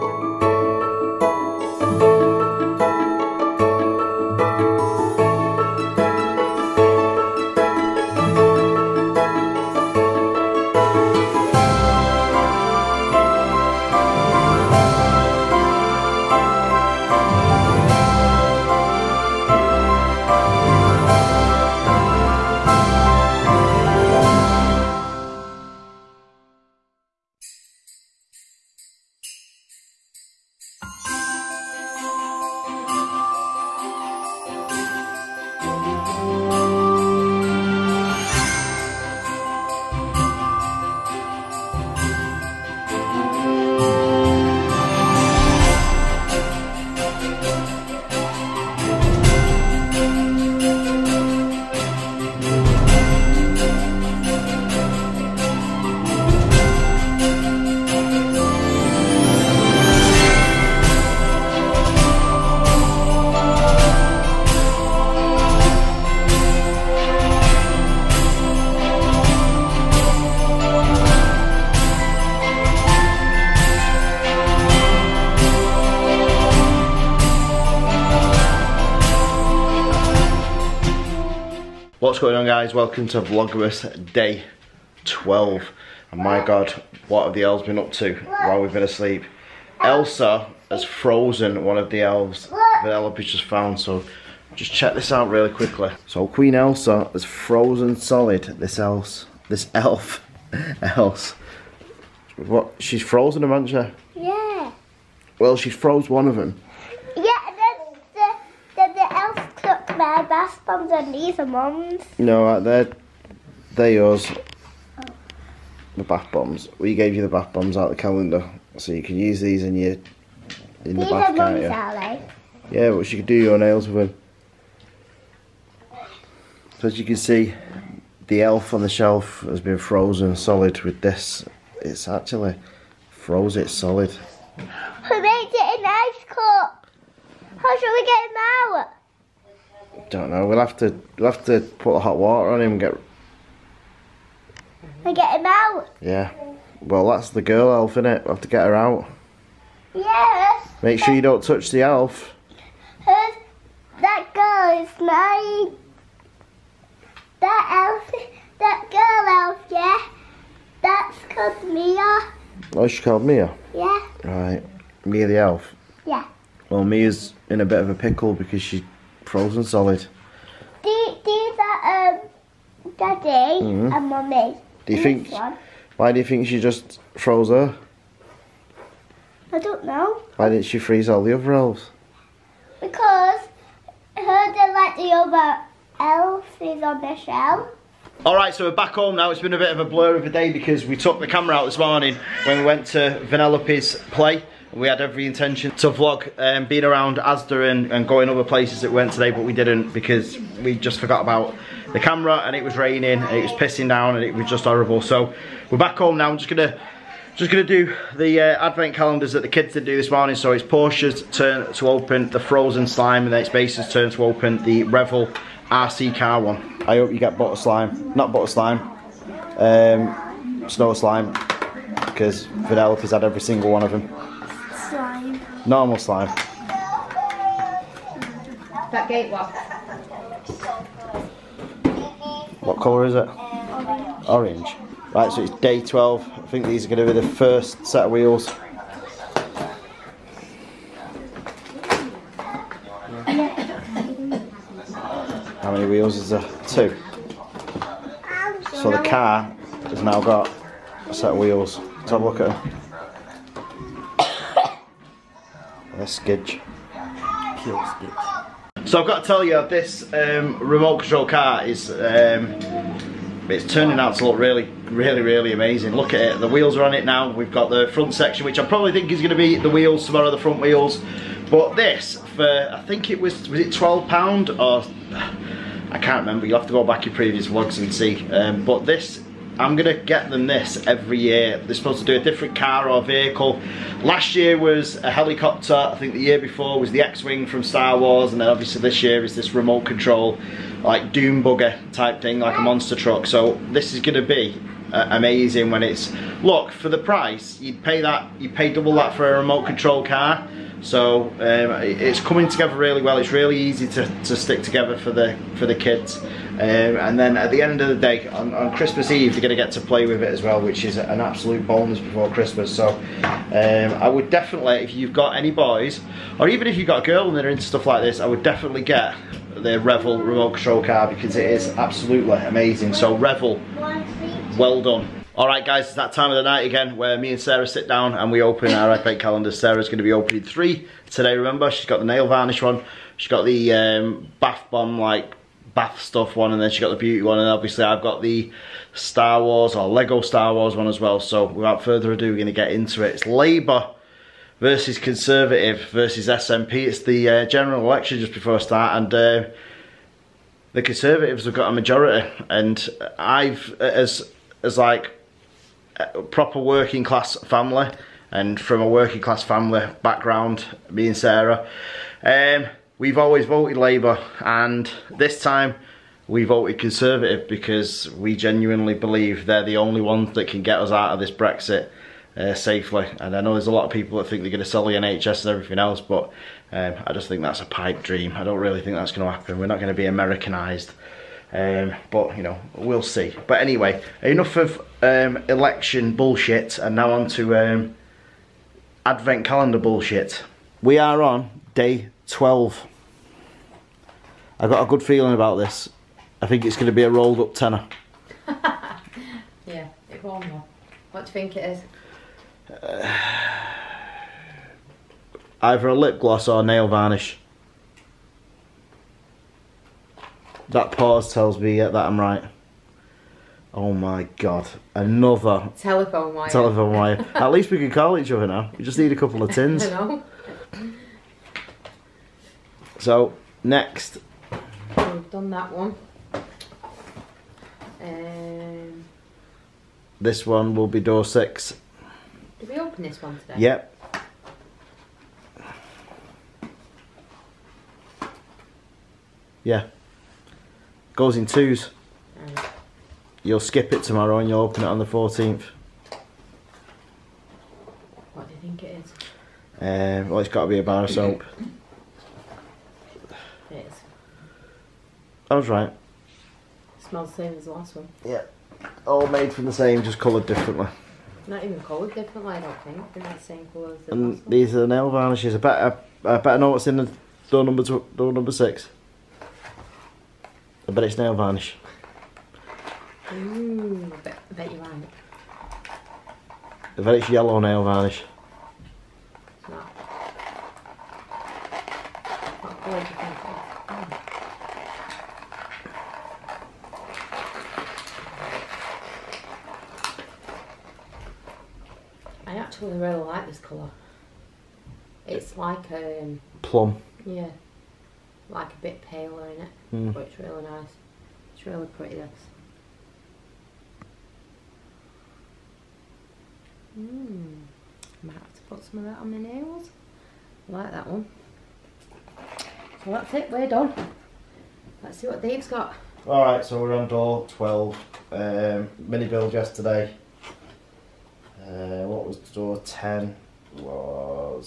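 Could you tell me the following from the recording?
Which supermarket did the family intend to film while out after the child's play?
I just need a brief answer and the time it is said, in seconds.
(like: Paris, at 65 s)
Asda, at 197 s.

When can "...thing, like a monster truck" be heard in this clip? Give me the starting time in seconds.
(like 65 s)
292 s.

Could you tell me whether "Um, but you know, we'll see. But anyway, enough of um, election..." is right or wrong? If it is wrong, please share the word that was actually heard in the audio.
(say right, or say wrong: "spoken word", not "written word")
right.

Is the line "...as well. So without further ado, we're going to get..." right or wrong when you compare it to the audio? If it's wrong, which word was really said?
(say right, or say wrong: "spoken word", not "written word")
right.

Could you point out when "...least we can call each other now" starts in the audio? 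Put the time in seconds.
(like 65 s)
417 s.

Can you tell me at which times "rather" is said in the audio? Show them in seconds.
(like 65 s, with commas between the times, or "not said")
not said.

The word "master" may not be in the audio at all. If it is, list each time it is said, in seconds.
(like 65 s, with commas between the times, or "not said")
not said.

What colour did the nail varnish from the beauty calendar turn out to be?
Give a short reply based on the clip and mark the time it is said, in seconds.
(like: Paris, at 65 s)
Yellow, at 477 s.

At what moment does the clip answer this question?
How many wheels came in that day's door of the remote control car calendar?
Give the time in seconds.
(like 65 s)
246 s.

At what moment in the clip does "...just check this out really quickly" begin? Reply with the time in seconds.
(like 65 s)
94 s.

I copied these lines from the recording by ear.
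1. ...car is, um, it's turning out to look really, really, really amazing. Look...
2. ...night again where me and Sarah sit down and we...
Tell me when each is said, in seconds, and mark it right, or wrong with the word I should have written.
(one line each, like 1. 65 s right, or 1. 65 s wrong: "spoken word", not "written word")
1. 261 s right
2. 326 s right.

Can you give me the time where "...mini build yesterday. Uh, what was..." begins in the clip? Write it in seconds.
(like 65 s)
518 s.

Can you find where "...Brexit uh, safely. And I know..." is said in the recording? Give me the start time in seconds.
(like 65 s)
371 s.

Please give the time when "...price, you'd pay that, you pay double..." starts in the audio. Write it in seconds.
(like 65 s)
296 s.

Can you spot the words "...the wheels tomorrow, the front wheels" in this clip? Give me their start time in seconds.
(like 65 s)
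269 s.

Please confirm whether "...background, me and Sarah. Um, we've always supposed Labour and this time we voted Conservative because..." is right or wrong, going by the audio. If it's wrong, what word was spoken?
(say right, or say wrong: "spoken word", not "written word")
wrong: "voted", not "supposed".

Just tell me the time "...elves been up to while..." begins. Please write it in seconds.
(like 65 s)
87 s.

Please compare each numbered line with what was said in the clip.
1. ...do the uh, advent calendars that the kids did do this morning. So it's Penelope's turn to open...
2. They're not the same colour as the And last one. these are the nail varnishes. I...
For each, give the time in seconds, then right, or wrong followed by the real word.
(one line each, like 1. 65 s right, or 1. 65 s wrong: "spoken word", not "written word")
1. 207 s wrong: "Porsha", not "Penelope"
2. 463 s right.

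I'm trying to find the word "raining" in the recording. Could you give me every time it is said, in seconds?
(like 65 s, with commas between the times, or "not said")
202 s.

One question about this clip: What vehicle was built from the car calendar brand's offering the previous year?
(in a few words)
A helicopter.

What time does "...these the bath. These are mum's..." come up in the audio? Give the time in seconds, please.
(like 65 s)
120 s.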